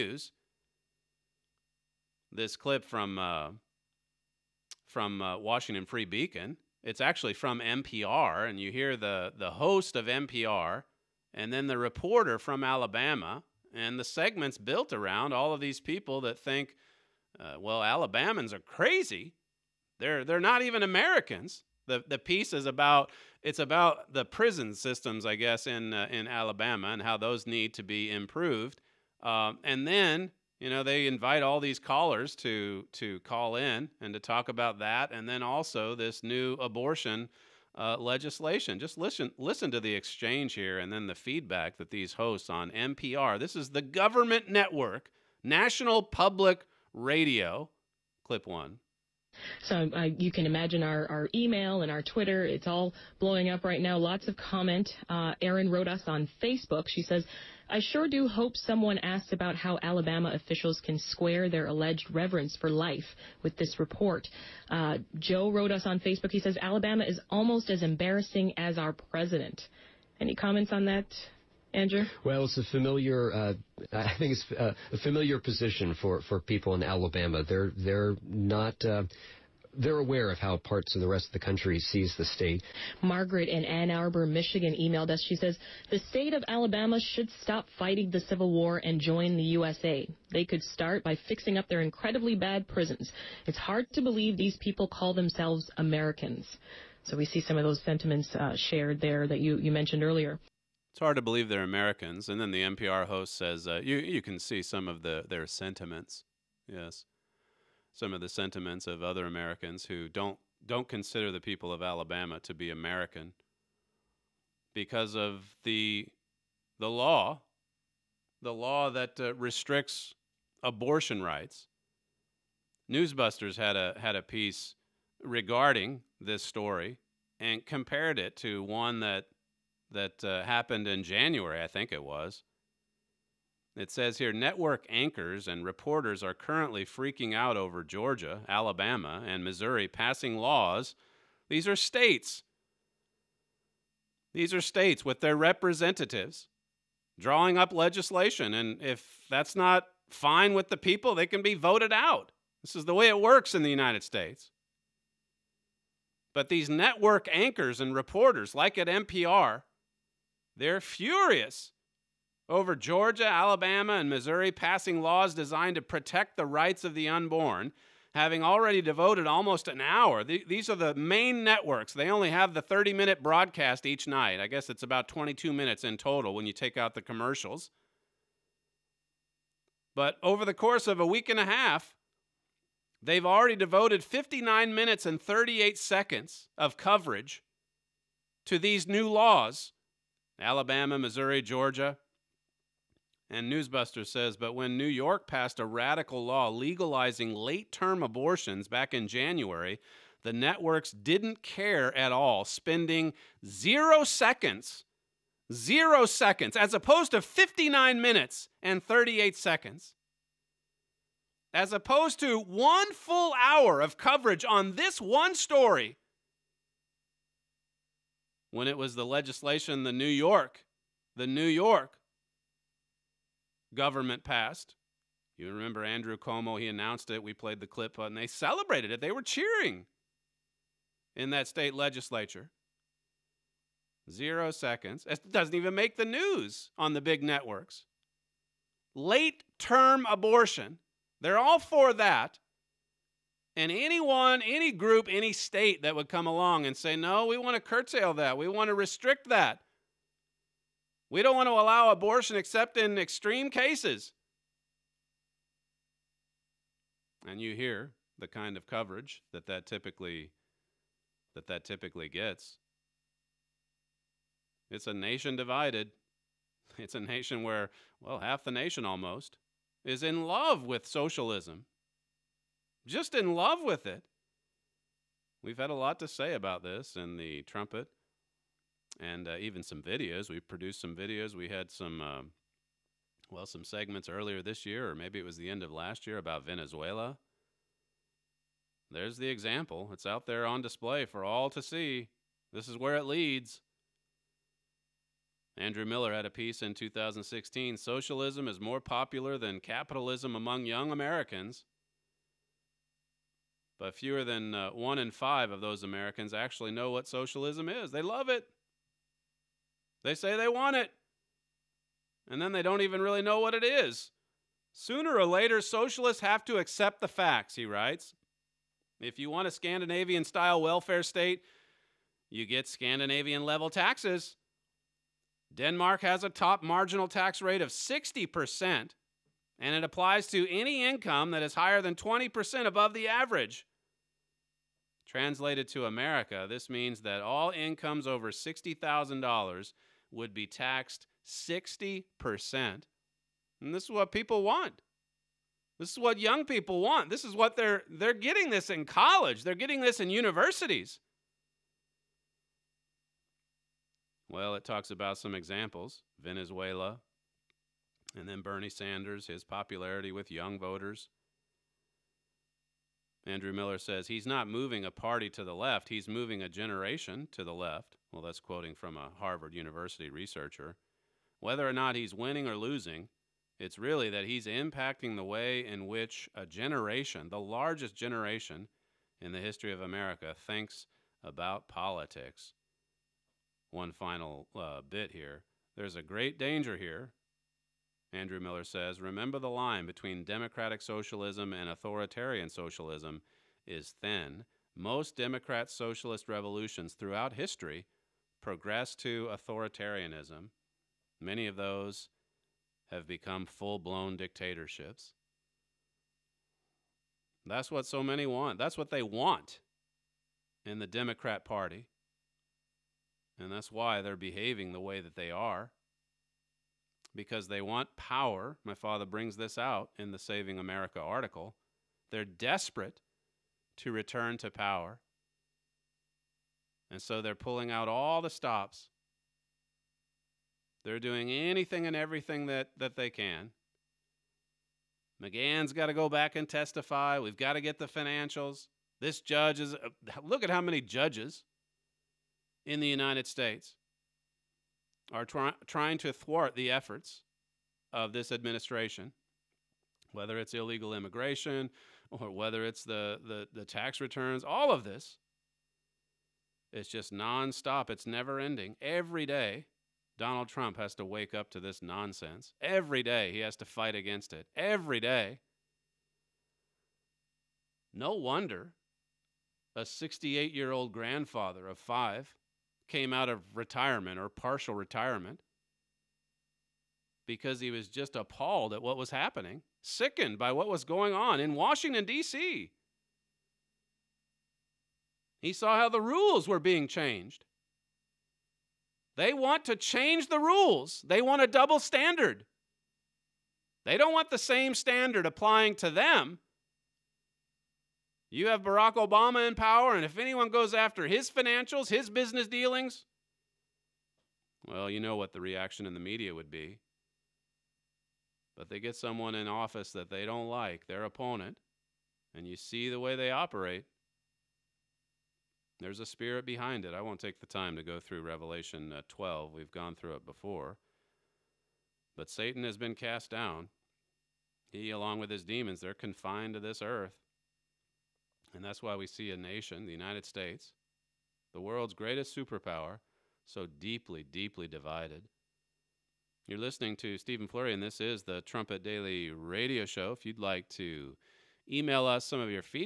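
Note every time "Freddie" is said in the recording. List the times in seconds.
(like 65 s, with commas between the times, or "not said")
not said.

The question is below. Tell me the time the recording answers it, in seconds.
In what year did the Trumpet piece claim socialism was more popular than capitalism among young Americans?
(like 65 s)
296 s.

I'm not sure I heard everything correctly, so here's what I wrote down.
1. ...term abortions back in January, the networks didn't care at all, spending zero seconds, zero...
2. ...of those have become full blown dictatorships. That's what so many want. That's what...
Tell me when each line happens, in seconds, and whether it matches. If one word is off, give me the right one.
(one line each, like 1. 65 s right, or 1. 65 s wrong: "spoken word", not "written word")
1. 197 s right
2. 401 s right.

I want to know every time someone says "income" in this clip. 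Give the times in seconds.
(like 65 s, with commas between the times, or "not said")
330 s, 337 s.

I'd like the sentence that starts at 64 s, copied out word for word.
Uh, Joe wrote us on Facebook.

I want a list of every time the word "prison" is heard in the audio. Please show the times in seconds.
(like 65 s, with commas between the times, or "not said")
24 s, 92 s.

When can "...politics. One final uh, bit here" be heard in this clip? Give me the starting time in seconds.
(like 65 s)
381 s.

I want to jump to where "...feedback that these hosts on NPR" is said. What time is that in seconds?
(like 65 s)
41 s.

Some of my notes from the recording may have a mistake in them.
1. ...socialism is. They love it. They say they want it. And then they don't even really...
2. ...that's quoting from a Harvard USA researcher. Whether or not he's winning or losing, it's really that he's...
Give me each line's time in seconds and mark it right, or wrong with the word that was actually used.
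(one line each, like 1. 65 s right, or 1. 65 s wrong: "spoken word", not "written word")
1. 307 s right
2. 368 s wrong: "University", not "USA".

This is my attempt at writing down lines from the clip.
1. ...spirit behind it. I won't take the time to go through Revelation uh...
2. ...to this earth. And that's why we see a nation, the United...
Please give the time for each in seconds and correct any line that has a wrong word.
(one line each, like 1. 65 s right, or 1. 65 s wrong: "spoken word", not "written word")
1. 516 s right
2. 526 s right.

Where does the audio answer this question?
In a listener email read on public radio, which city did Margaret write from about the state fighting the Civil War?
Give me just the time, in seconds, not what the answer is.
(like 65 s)
83 s.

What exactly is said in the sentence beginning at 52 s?
It's all blowing up right now.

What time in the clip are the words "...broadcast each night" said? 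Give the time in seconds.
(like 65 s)
173 s.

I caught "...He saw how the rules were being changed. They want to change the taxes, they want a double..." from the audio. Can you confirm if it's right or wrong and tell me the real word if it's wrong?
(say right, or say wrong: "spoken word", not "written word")
wrong: "rules", not "taxes".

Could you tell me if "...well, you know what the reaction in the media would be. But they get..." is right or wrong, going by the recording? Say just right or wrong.
right.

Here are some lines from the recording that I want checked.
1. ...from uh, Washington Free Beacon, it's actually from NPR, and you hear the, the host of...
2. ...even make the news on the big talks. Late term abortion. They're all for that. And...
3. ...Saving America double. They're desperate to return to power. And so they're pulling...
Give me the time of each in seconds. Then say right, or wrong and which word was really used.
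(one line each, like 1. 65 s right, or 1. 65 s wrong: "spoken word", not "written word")
1. 4 s right
2. 235 s wrong: "networks", not "talks"
3. 420 s wrong: "article", not "double".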